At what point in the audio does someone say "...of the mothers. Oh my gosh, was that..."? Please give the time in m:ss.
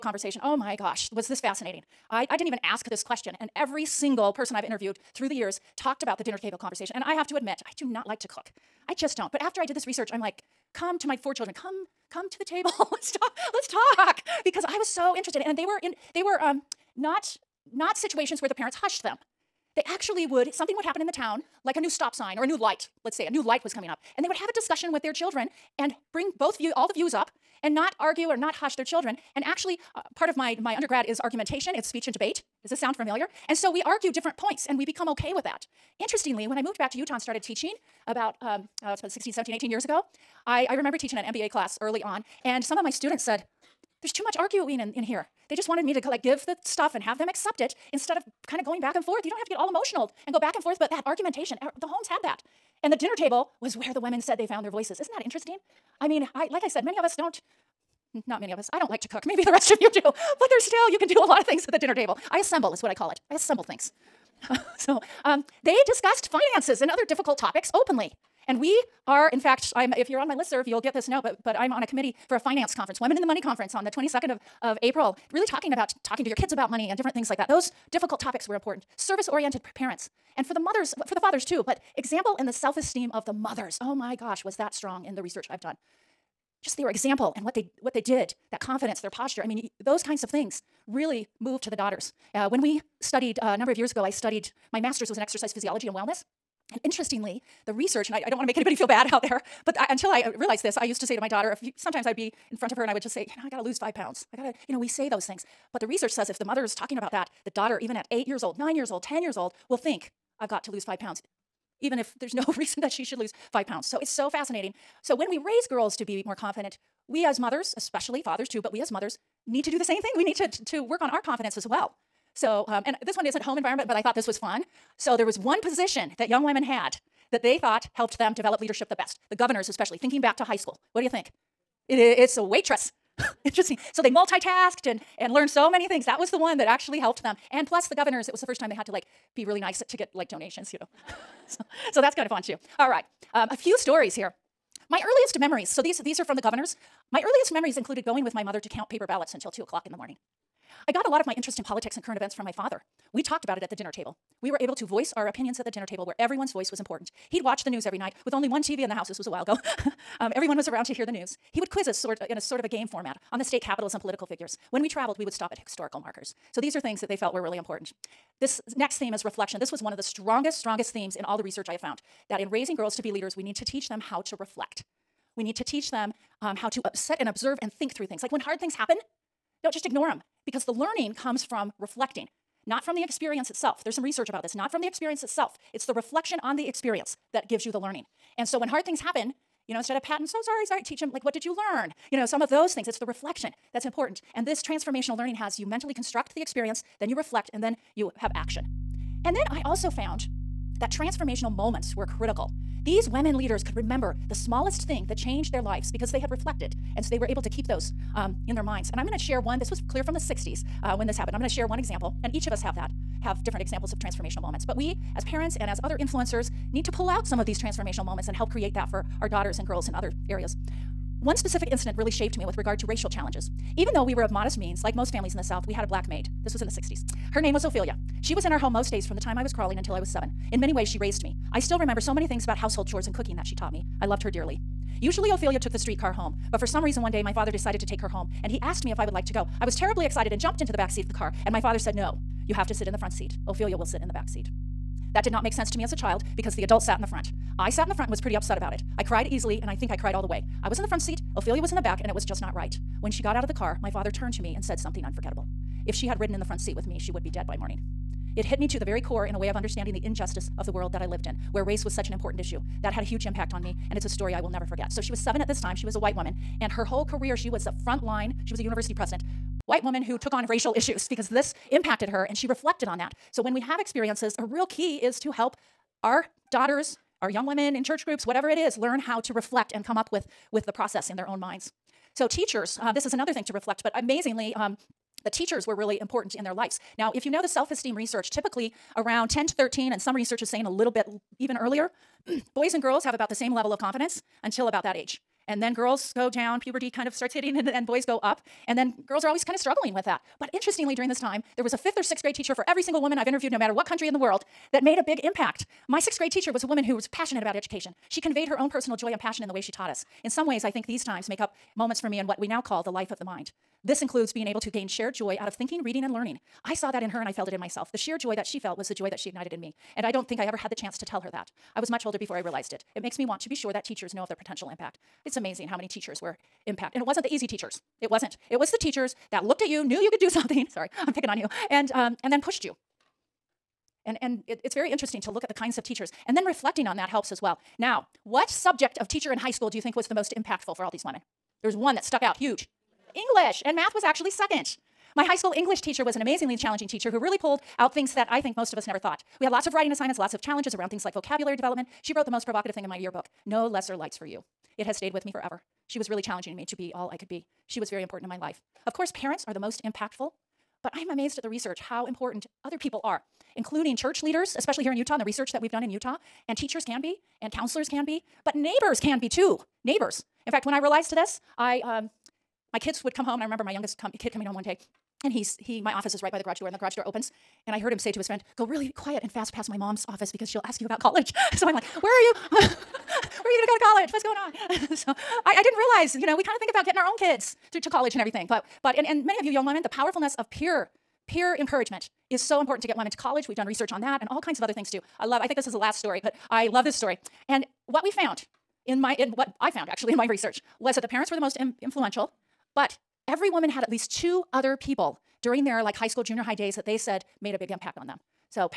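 1:23.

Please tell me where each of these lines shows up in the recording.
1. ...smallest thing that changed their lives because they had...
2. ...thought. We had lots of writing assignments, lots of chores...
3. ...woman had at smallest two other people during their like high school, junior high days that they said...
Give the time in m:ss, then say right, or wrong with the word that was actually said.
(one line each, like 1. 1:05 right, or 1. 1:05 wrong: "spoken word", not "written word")
1. 3:24 right
2. 5:48 wrong: "challenges", not "chores"
3. 6:43 wrong: "least", not "smallest".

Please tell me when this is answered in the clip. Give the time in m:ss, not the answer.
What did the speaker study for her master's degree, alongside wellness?
1:35.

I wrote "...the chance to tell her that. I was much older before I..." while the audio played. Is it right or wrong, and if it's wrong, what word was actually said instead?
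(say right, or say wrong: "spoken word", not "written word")
right.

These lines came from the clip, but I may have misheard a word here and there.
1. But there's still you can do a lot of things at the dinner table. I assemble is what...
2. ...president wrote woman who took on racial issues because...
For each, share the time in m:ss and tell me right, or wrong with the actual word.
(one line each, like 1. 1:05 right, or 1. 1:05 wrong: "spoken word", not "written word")
1. 1:00 right
2. 4:28 wrong: "white", not "wrote".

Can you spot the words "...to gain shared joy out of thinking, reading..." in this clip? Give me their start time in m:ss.
5:14.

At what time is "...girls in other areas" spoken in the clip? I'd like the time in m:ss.
3:39.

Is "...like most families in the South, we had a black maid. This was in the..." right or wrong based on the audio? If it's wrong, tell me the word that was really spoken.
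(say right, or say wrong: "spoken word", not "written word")
right.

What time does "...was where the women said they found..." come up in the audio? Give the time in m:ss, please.
0:53.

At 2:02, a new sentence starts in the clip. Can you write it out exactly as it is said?
So, um, and this one isn't home environment, but I thought this was fun.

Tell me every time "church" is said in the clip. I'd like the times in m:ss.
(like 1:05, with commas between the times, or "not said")
4:37, 6:03.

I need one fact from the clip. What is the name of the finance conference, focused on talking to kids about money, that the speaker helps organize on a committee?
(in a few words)
Women in the Money Conference.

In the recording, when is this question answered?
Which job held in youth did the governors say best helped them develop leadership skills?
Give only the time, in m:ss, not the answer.
2:12.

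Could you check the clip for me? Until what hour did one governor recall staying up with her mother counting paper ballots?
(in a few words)
2 o'clock in the morning.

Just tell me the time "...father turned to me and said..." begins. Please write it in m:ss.
4:13.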